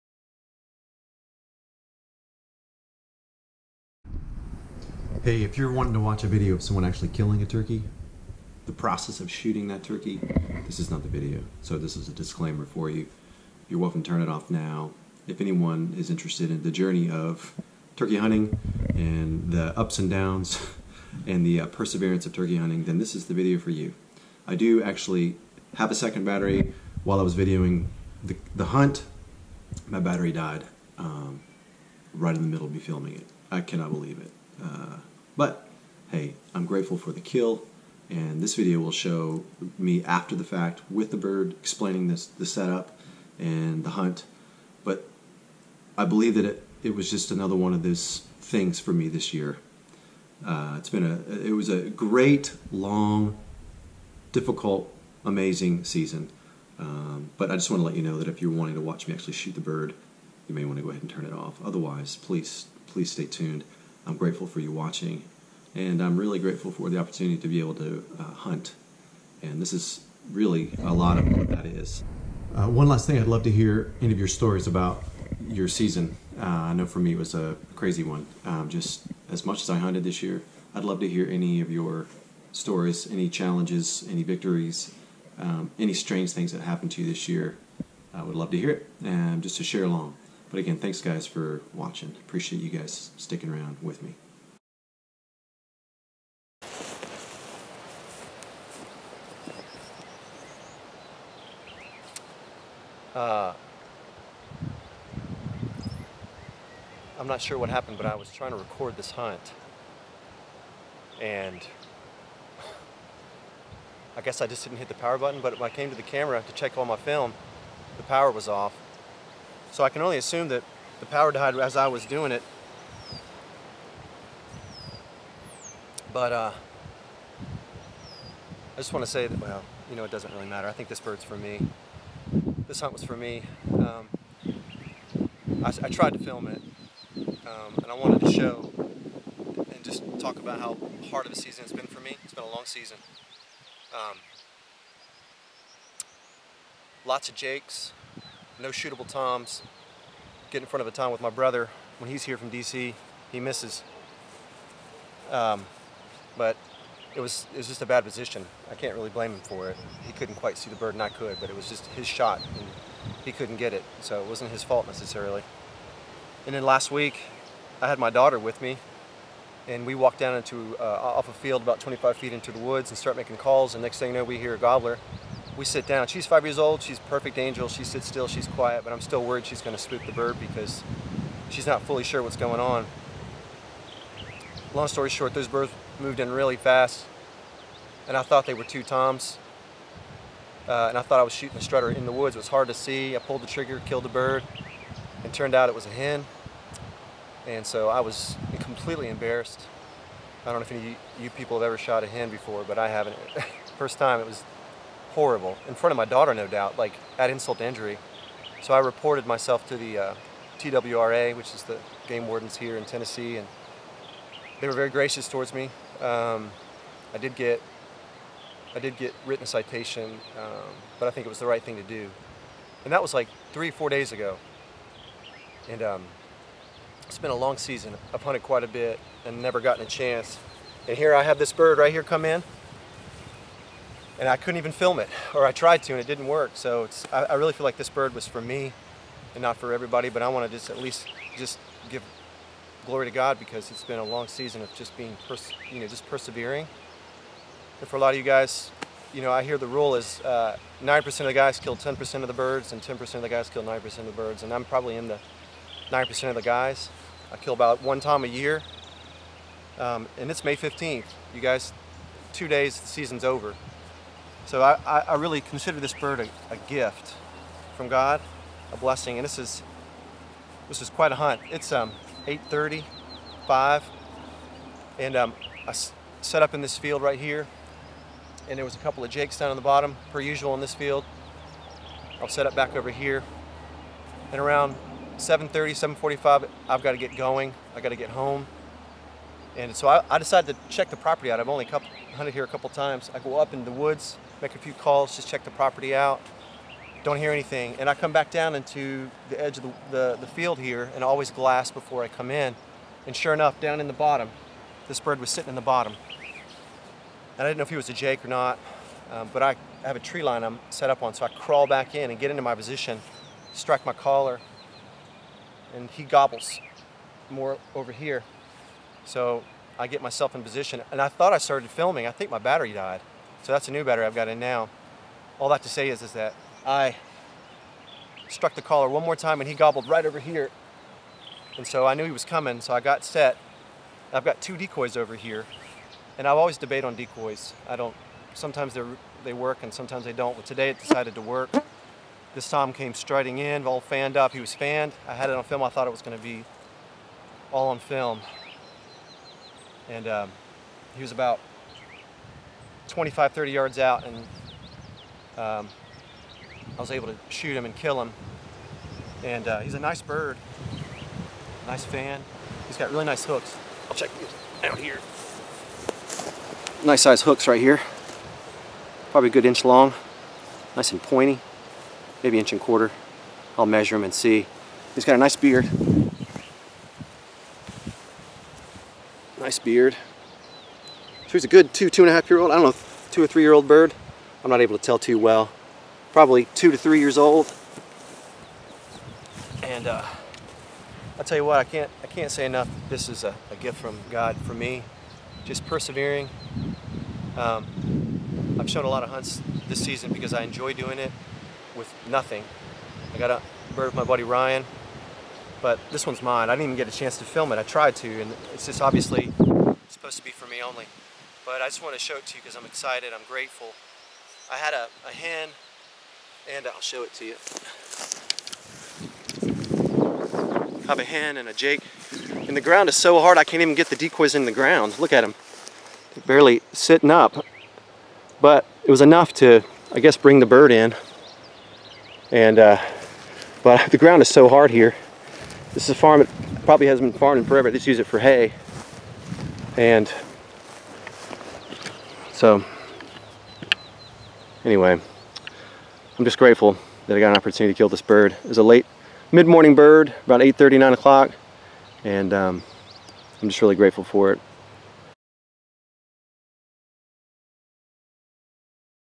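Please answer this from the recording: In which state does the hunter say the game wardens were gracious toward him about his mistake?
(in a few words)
Tennessee.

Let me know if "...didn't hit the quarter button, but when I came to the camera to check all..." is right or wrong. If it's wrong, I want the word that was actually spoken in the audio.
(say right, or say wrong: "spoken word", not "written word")
wrong: "power", not "quarter".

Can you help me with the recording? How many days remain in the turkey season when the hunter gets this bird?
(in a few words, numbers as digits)
2.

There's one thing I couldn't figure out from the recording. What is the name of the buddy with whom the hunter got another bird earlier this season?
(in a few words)
Ryan.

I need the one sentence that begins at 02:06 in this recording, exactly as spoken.
But uh, I just want to say that, well, you know, it doesn't really matter.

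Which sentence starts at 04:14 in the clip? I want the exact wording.
And I'm probably in the 9% of the guys.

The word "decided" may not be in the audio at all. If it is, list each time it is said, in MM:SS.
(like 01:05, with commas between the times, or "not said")
04:50, 05:40.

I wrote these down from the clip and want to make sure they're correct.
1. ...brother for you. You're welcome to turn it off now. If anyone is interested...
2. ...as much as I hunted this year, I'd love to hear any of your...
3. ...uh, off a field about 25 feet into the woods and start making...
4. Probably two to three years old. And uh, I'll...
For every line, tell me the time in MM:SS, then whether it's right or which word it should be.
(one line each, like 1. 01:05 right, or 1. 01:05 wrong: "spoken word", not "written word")
1. 00:12 wrong: "disclaimer", not "brother"
2. 01:19 right
3. 02:50 right
4. 06:26 right.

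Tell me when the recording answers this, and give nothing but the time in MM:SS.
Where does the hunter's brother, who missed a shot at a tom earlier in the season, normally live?
02:32.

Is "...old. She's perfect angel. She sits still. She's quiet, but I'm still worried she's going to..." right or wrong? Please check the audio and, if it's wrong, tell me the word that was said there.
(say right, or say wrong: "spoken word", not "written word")
right.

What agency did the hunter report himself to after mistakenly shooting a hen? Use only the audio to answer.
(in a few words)
TWRA.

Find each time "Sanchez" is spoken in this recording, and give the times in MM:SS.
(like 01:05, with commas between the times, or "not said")
not said.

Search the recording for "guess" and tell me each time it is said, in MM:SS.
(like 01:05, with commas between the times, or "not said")
01:54, 07:09.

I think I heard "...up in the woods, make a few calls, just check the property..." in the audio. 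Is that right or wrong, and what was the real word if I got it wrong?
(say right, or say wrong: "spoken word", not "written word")
right.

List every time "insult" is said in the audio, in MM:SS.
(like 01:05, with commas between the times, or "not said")
03:27.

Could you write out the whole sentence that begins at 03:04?
Long story short, those birds moved in really fast, and I thought they were two toms.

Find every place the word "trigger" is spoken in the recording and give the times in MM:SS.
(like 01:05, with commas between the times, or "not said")
03:13.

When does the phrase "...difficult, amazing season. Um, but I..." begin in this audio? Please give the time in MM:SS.
00:54.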